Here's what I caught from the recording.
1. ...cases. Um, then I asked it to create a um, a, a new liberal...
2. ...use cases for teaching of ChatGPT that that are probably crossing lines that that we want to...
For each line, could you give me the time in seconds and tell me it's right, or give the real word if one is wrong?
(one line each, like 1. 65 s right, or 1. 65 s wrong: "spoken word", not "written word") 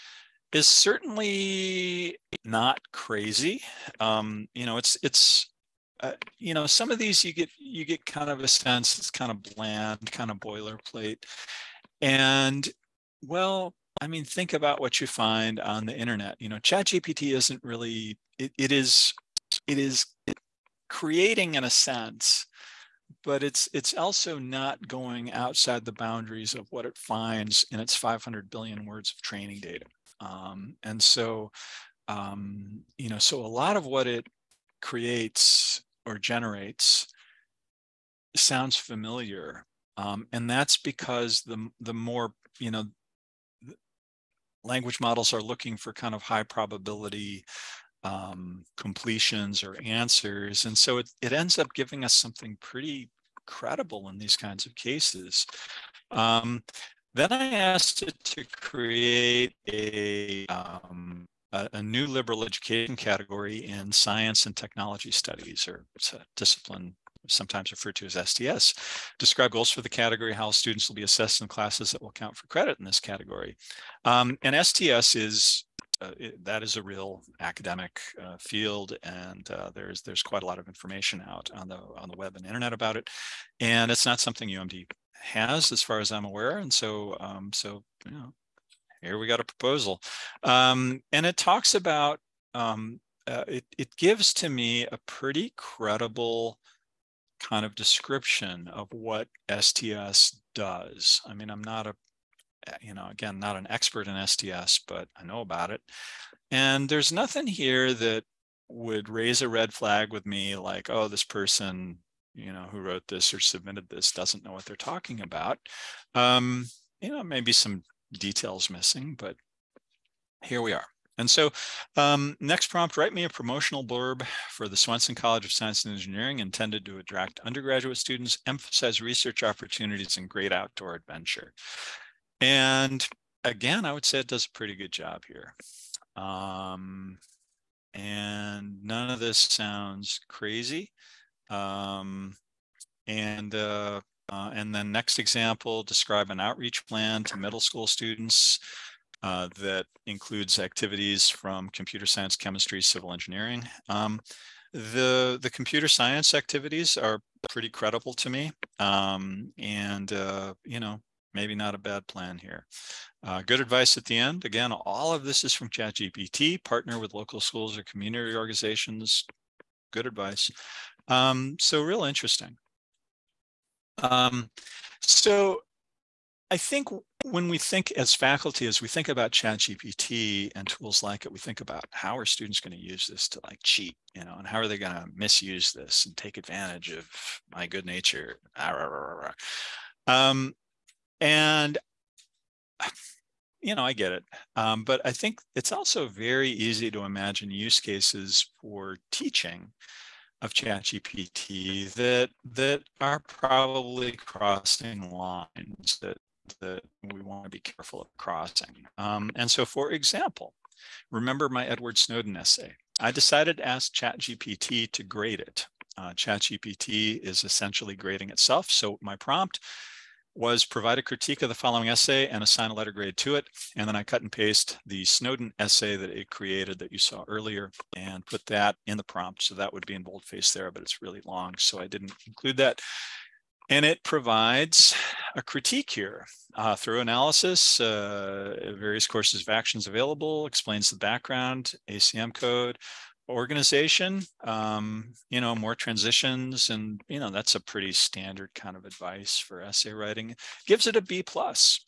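1. 54 s right
2. 197 s right.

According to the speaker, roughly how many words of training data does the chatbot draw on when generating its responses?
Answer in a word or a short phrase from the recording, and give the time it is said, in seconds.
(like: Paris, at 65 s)
500 billion, at 27 s.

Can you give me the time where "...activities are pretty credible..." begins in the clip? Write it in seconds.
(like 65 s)
156 s.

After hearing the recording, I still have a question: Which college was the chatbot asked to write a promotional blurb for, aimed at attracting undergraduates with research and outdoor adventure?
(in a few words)
Swanson College of Science and Engineering.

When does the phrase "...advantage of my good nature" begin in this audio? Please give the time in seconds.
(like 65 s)
186 s.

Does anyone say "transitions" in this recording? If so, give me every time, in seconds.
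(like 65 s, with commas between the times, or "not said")
245 s.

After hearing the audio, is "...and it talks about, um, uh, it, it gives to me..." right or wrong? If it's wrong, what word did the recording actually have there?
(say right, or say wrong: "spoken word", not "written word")
right.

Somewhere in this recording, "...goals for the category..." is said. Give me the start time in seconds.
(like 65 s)
69 s.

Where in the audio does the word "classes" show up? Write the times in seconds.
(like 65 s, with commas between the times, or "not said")
71 s.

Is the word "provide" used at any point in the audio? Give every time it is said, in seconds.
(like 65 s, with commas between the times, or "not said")
220 s, 234 s.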